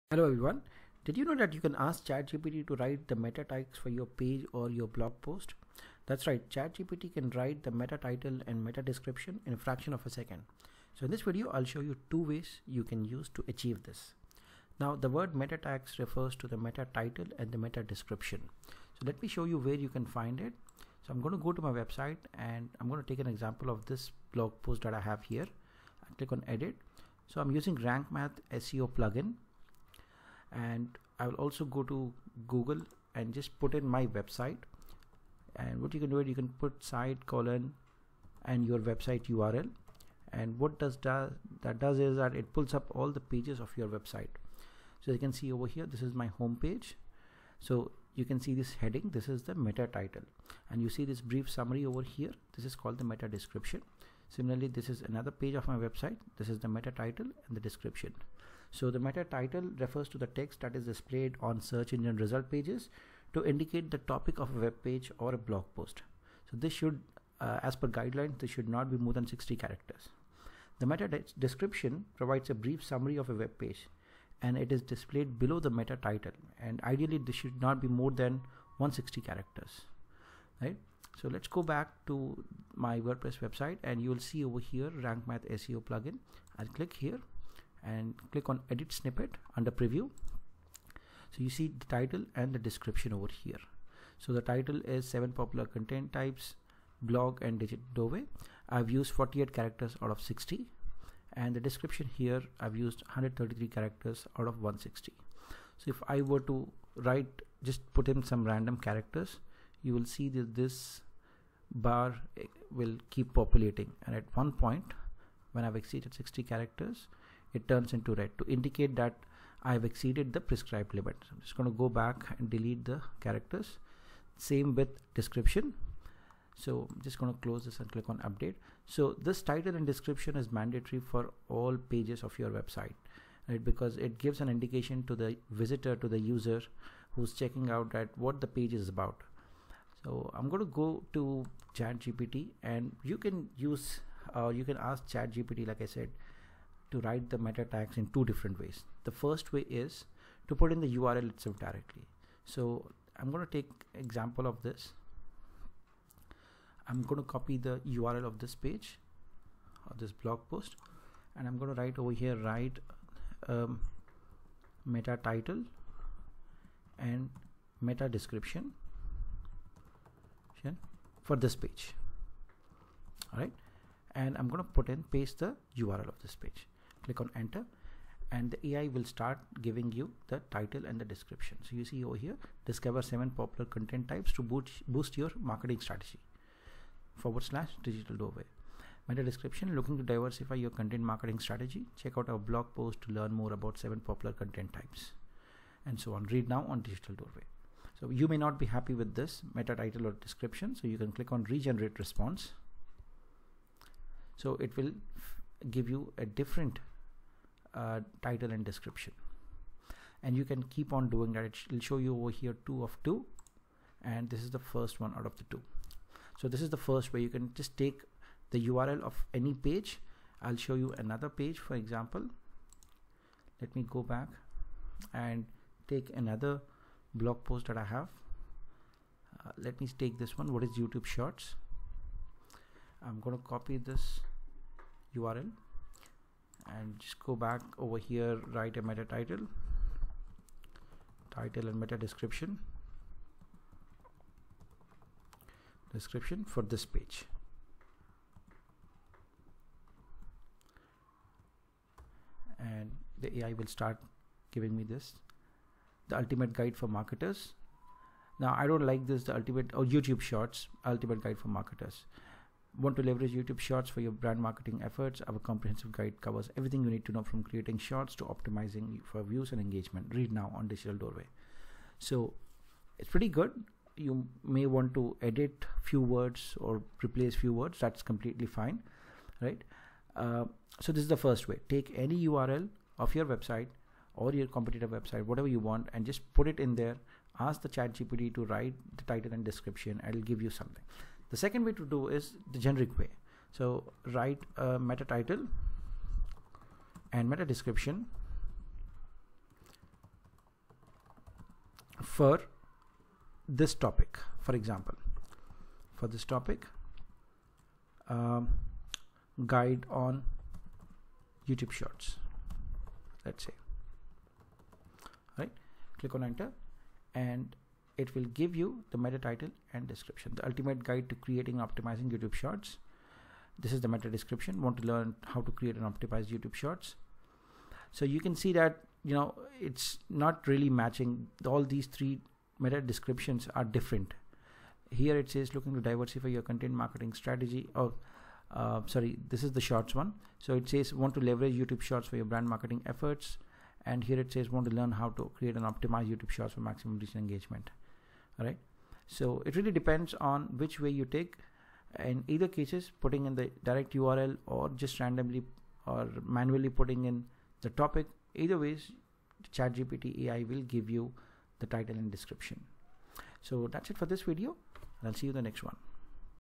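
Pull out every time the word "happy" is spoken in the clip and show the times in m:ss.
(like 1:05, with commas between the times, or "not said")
3:18.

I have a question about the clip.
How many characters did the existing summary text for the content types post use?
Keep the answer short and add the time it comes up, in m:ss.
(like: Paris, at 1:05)
133, at 1:43.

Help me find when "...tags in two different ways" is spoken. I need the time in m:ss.
2:27.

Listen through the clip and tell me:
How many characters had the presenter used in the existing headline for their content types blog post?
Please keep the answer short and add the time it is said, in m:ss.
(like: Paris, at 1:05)
48, at 1:39.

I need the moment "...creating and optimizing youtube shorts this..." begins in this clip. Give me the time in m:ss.
5:21.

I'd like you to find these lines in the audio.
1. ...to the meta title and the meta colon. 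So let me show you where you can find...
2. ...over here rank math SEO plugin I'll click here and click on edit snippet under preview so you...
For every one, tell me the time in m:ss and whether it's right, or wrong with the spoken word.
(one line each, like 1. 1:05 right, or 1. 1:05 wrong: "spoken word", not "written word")
1. 0:16 wrong: "description", not "colon"
2. 1:24 right.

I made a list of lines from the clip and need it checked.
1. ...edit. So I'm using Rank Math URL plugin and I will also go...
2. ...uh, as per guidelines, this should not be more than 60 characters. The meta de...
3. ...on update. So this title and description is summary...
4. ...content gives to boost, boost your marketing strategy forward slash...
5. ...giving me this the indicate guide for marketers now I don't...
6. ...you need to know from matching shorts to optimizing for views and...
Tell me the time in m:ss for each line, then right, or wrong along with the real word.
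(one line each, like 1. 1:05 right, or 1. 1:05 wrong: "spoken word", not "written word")
1. 0:26 wrong: "SEO", not "URL"
2. 1:07 right
3. 2:08 wrong: "mandatory", not "summary"
4. 3:03 wrong: "types", not "gives"
5. 4:14 wrong: "ultimate", not "indicate"
6. 4:26 wrong: "creating", not "matching".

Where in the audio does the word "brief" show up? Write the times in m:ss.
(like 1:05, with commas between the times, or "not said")
0:51, 1:12.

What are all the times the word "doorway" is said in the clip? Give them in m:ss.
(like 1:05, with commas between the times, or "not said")
1:37, 3:08, 3:17, 4:30.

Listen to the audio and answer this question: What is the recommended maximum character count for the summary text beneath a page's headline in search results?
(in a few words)
160.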